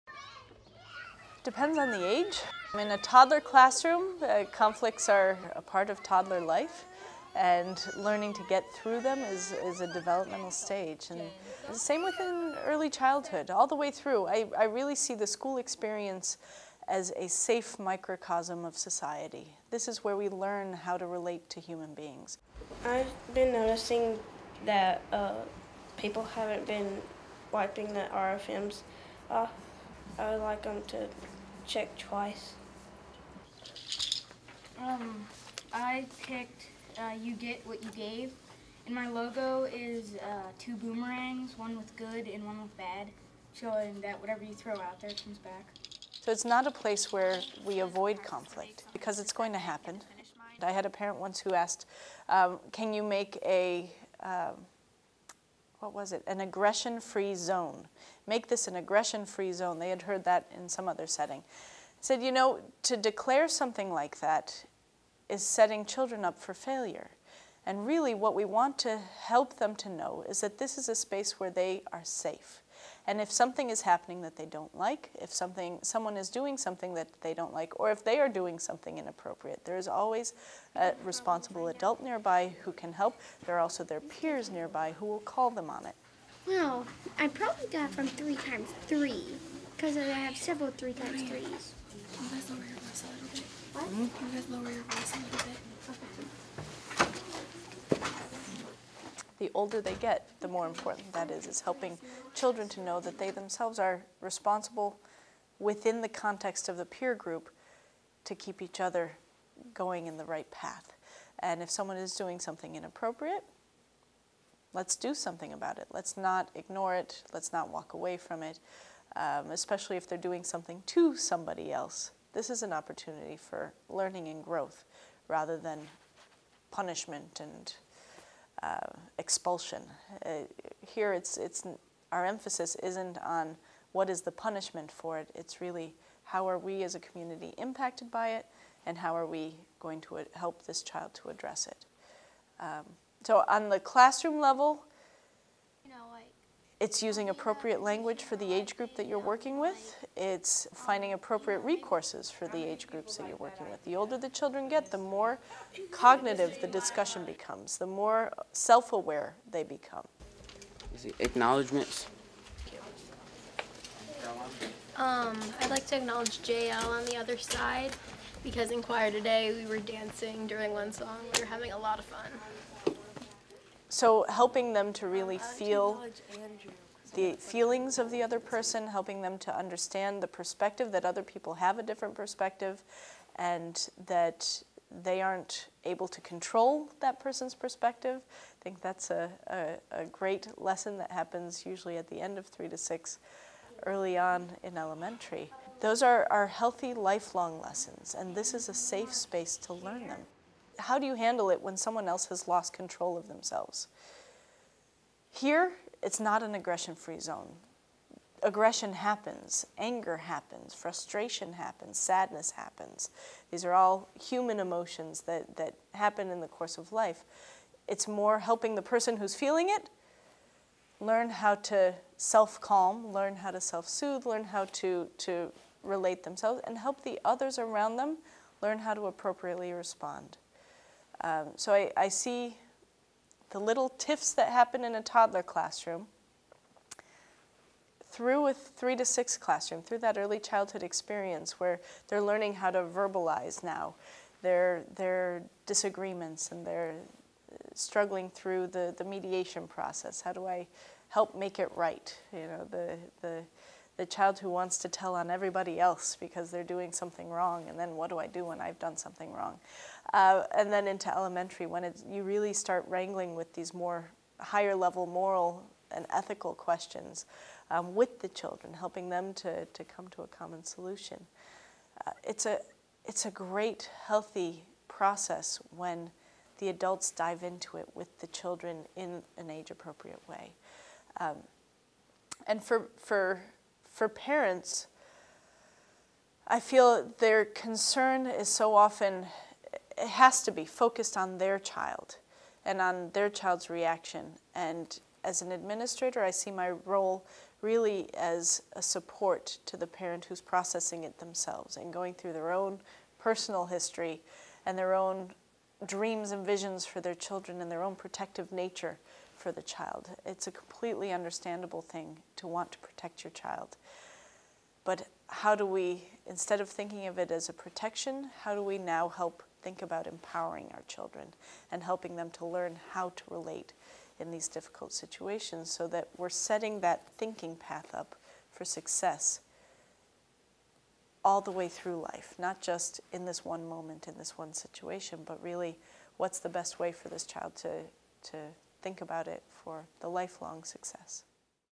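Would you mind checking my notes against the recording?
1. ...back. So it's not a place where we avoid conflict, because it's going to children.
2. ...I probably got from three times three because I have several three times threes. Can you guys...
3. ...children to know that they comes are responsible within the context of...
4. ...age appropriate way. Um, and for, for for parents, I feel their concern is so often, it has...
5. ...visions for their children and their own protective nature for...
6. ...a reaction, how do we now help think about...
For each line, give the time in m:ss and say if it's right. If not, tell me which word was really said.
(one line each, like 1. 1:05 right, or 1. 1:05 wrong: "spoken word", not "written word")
1. 0:45 wrong: "happen", not "children"
2. 1:27 right
3. 1:42 wrong: "themselves", not "comes"
4. 4:39 right
5. 5:06 right
6. 5:17 wrong: "protection", not "reaction".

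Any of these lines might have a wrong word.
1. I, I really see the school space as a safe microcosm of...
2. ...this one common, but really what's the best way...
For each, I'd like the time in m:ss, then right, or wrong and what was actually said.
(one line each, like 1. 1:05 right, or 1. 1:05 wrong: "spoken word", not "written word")
1. 0:14 wrong: "experience", not "space"
2. 5:34 wrong: "situation", not "common".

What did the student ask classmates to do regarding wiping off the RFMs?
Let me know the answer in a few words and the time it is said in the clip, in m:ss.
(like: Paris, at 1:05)
check twice, at 0:31.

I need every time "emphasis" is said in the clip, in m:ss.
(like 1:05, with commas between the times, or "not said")
2:12.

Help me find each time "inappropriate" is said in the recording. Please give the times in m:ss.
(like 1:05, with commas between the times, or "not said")
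1:18, 1:52.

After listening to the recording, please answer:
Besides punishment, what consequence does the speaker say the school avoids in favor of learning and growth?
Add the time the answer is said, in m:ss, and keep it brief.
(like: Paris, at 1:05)
expulsion, at 2:09.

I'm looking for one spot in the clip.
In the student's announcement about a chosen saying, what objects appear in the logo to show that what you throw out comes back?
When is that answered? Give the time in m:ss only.
0:40.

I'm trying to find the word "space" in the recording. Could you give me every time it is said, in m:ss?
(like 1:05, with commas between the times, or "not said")
1:10, 3:19.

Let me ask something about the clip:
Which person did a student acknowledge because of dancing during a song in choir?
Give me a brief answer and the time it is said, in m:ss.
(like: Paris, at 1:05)
JL, at 2:46.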